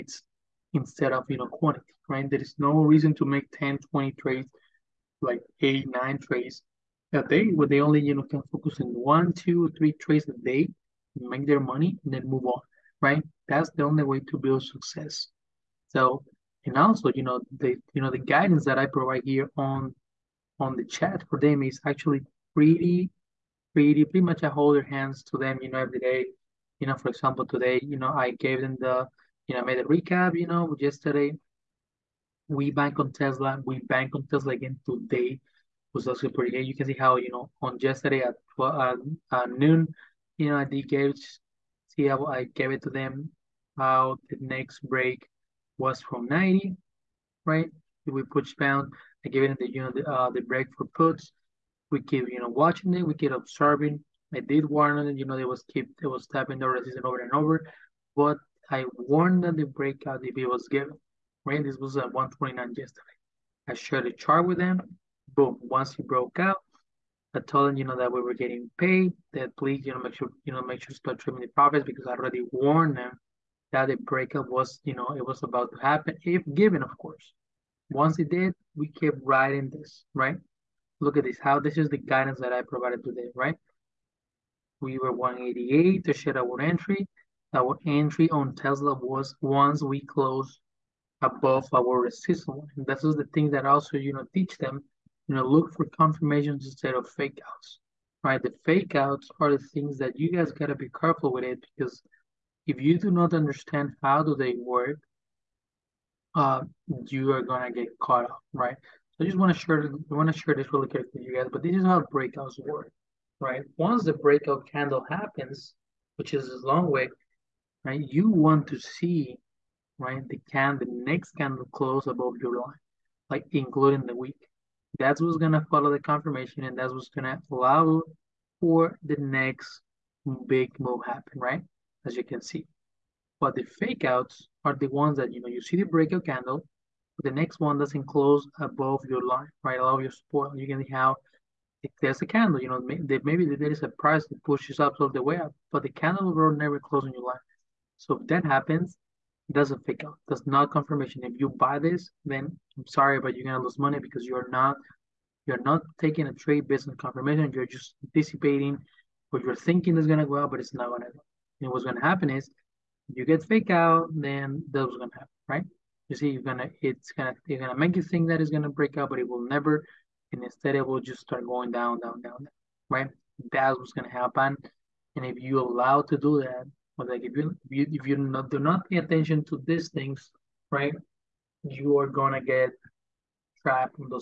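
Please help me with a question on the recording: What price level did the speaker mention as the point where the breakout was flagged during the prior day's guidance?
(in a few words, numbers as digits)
129.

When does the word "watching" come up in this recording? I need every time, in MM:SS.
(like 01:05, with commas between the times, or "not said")
00:52.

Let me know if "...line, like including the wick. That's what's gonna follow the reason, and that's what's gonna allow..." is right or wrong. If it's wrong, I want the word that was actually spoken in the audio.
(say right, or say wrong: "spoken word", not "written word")
wrong: "confirmation", not "reason".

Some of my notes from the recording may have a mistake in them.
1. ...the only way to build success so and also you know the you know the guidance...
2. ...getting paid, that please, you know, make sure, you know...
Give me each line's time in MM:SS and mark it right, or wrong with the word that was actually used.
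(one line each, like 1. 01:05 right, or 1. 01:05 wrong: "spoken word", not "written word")
1. 00:13 right
2. 01:08 right.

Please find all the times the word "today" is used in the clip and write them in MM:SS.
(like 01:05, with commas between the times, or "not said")
00:27, 00:34, 01:23.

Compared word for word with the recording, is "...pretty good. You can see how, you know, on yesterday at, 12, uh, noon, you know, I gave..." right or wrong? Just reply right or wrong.
right.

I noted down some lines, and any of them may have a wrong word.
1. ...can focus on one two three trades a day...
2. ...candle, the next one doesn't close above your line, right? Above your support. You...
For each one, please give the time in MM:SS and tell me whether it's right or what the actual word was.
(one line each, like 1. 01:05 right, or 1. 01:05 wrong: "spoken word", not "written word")
1. 00:08 right
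2. 02:16 right.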